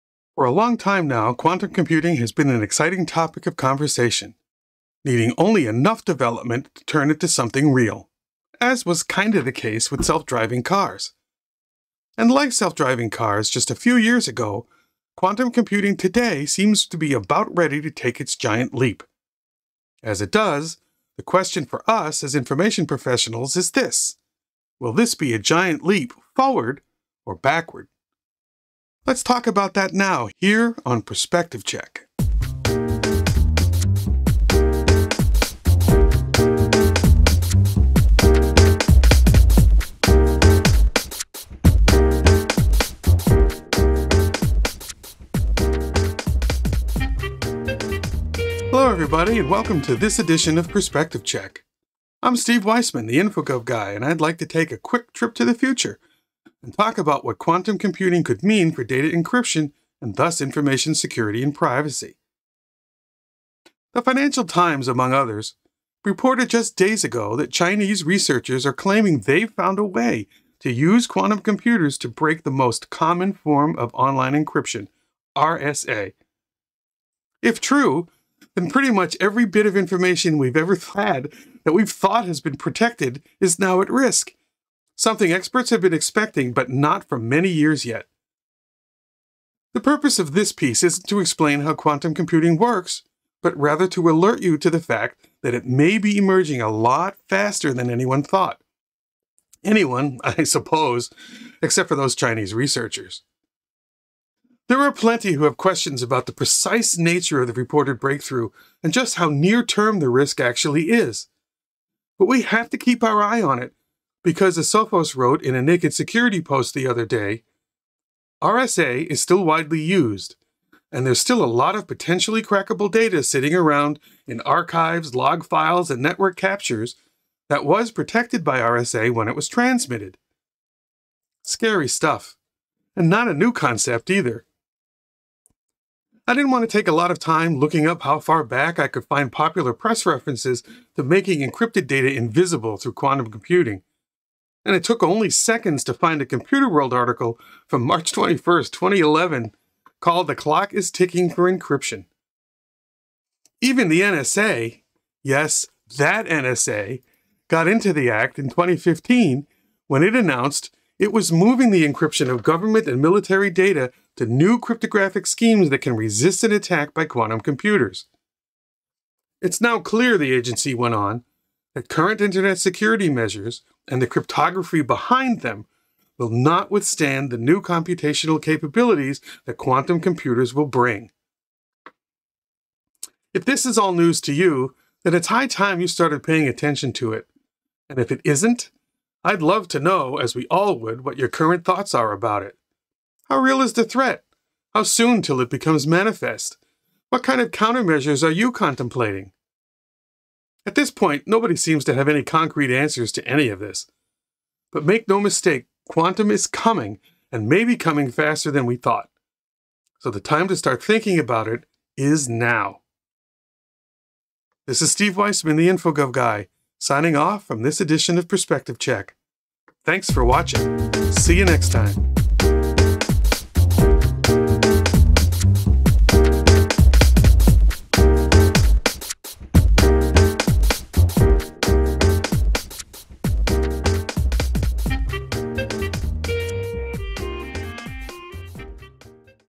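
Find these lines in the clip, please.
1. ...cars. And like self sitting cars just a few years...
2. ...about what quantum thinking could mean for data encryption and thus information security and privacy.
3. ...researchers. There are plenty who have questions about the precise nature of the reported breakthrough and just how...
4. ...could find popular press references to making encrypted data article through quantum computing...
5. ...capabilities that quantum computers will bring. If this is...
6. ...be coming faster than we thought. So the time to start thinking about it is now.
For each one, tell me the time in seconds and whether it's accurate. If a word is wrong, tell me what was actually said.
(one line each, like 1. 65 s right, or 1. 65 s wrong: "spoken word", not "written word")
1. 10 s wrong: "driving", not "sitting"
2. 56 s wrong: "computing", not "thinking"
3. 102 s right
4. 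138 s wrong: "invisible", not "article"
5. 178 s right
6. 207 s right.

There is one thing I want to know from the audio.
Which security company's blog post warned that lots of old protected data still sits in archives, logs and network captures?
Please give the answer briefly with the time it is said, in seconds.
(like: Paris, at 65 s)
Sophos, at 114 s.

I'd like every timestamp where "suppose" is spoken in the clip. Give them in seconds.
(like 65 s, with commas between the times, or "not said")
100 s.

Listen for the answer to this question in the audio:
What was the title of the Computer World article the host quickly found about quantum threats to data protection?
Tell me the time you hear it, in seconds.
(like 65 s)
150 s.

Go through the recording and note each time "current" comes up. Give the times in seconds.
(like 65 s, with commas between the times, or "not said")
171 s, 191 s.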